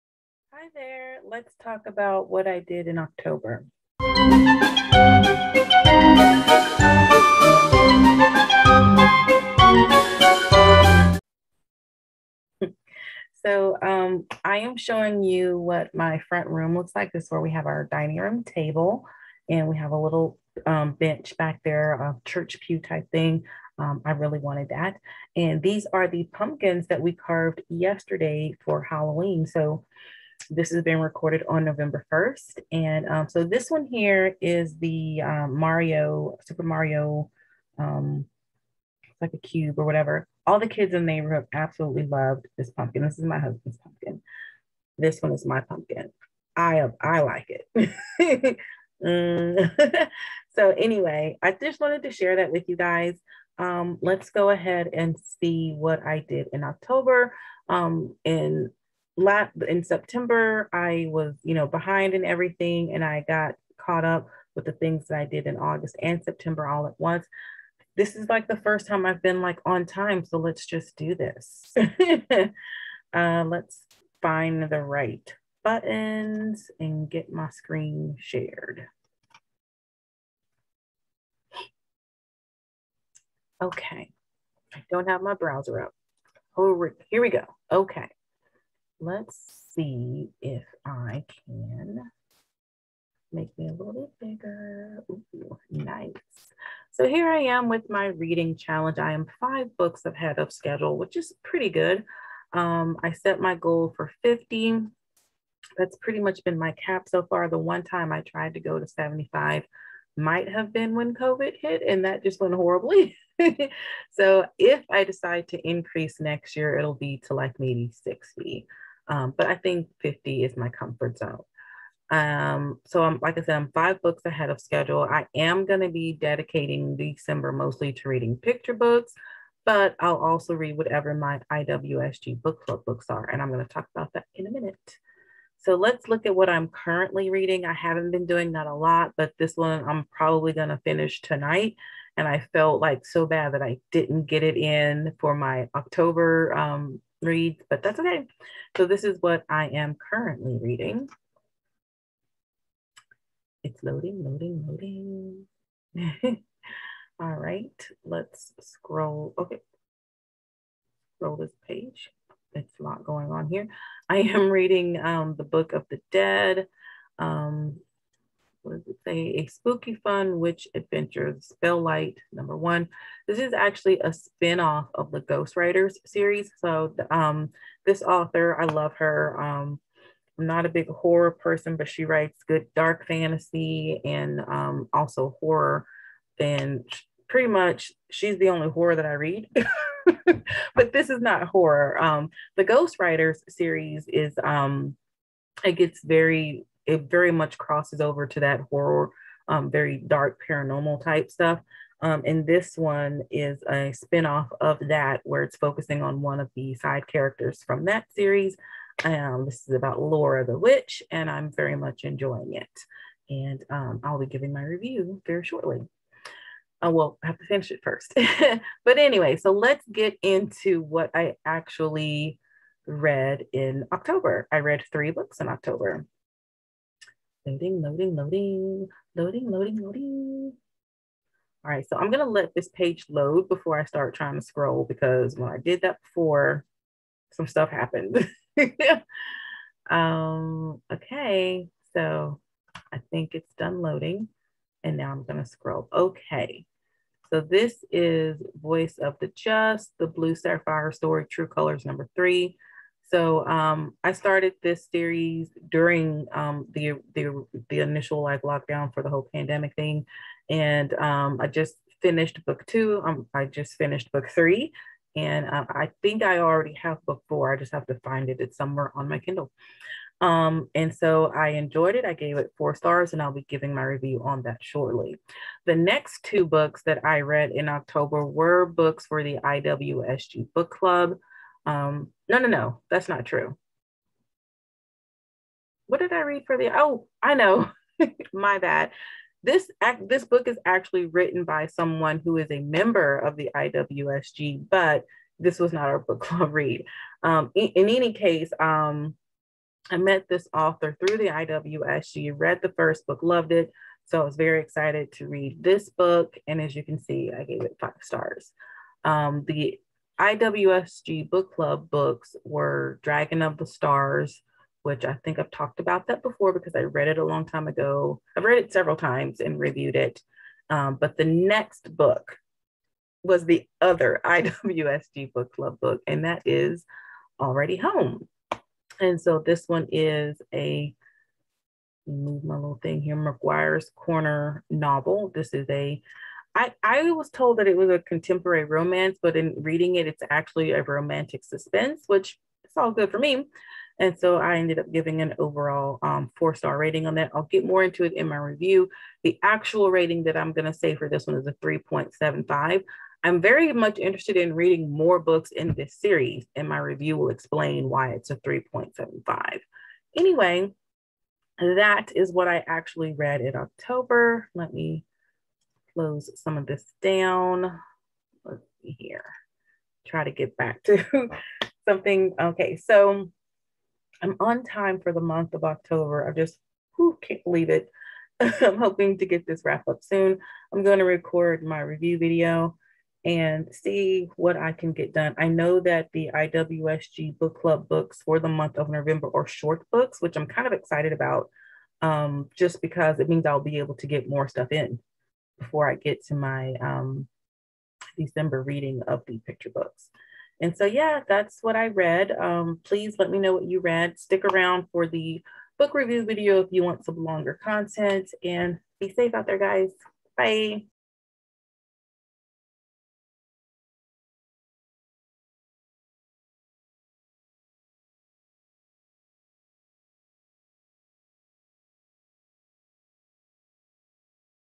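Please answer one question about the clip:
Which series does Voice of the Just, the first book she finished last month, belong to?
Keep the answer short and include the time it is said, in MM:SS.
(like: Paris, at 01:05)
True Colors, at 04:11.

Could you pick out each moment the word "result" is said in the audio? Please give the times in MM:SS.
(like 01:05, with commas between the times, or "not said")
not said.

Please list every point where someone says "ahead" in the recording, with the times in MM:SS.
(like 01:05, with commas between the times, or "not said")
00:54, 01:40, 02:04.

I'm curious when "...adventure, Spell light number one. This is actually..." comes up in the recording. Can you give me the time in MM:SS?
02:50.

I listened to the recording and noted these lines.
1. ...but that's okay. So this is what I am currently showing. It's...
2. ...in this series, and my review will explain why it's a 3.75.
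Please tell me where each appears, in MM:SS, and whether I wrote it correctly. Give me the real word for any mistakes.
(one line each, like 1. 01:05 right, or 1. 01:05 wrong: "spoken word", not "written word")
1. 02:27 wrong: "reading", not "showing"
2. 05:55 right.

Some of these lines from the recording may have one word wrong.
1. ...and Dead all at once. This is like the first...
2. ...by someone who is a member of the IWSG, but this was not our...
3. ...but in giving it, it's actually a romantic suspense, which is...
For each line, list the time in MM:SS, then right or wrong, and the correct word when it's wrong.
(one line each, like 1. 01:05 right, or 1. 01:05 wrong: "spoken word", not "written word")
1. 01:06 wrong: "September", not "Dead"
2. 04:51 right
3. 05:39 wrong: "reading", not "giving".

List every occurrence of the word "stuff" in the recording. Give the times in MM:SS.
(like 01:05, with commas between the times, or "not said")
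03:21, 03:57, 06:34.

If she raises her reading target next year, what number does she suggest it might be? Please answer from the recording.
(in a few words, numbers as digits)
60.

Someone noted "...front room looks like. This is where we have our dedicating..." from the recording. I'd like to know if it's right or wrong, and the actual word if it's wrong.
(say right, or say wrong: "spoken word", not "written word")
wrong: "dining", not "dedicating".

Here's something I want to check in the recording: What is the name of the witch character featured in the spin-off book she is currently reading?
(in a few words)
Laura.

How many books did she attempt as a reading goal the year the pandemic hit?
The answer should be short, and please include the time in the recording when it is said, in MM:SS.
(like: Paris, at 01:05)
75, at 01:48.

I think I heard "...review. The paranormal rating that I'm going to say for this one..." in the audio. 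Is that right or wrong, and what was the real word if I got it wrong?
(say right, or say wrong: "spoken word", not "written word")
wrong: "actual", not "paranormal".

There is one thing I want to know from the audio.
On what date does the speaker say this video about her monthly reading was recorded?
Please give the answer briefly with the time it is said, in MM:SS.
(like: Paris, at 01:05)
November 1st, at 00:31.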